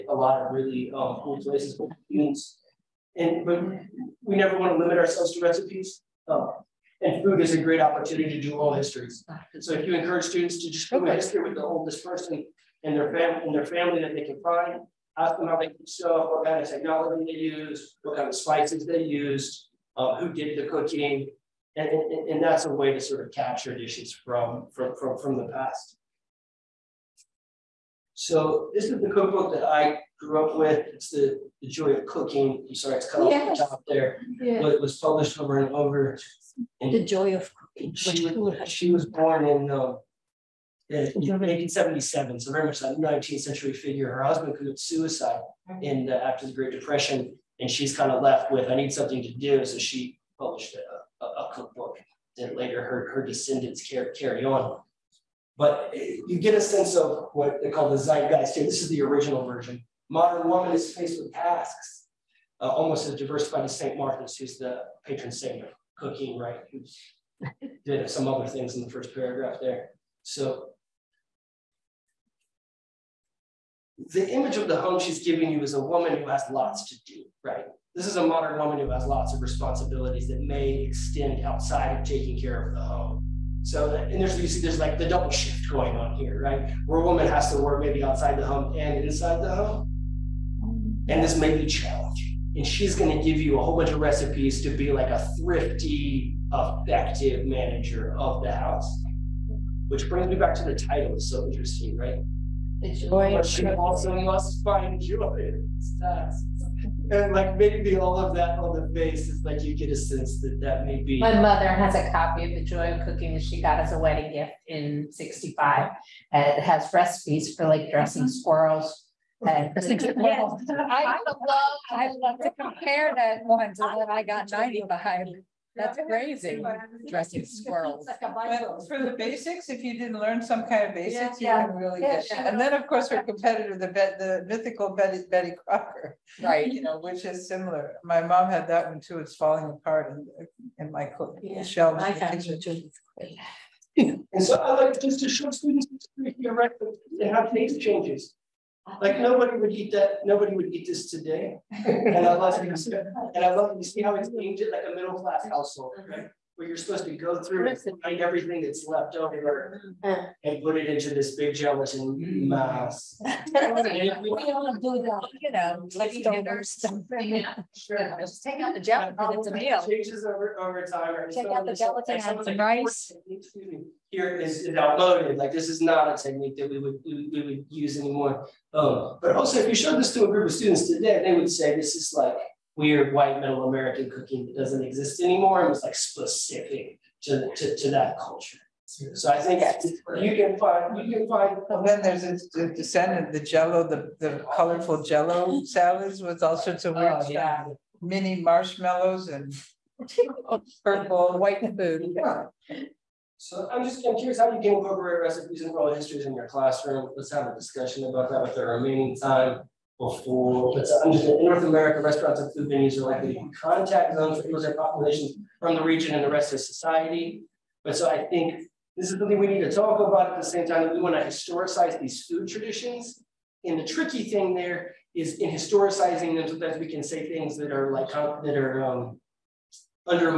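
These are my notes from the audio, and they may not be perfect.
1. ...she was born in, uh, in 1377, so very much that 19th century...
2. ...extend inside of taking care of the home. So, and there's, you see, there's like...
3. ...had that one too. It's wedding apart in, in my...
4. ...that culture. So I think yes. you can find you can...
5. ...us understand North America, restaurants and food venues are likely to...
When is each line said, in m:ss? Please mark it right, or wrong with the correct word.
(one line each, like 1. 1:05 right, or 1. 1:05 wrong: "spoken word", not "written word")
1. 0:38 wrong: "1877", not "1377"
2. 1:20 wrong: "outside", not "inside"
3. 2:18 wrong: "falling", not "wedding"
4. 3:07 right
5. 3:30 right.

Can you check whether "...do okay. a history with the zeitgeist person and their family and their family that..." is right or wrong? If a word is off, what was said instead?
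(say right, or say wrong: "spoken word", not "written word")
wrong: "oldest", not "zeitgeist".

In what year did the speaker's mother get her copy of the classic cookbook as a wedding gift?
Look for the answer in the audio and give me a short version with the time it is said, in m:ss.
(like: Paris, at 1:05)
1965, at 1:55.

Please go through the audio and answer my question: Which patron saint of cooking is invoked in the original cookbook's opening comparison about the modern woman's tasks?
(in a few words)
St. Martha.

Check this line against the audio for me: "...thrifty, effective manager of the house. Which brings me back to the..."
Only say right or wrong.
right.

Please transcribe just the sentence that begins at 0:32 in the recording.
I'm sorry, it's cut off at the top there.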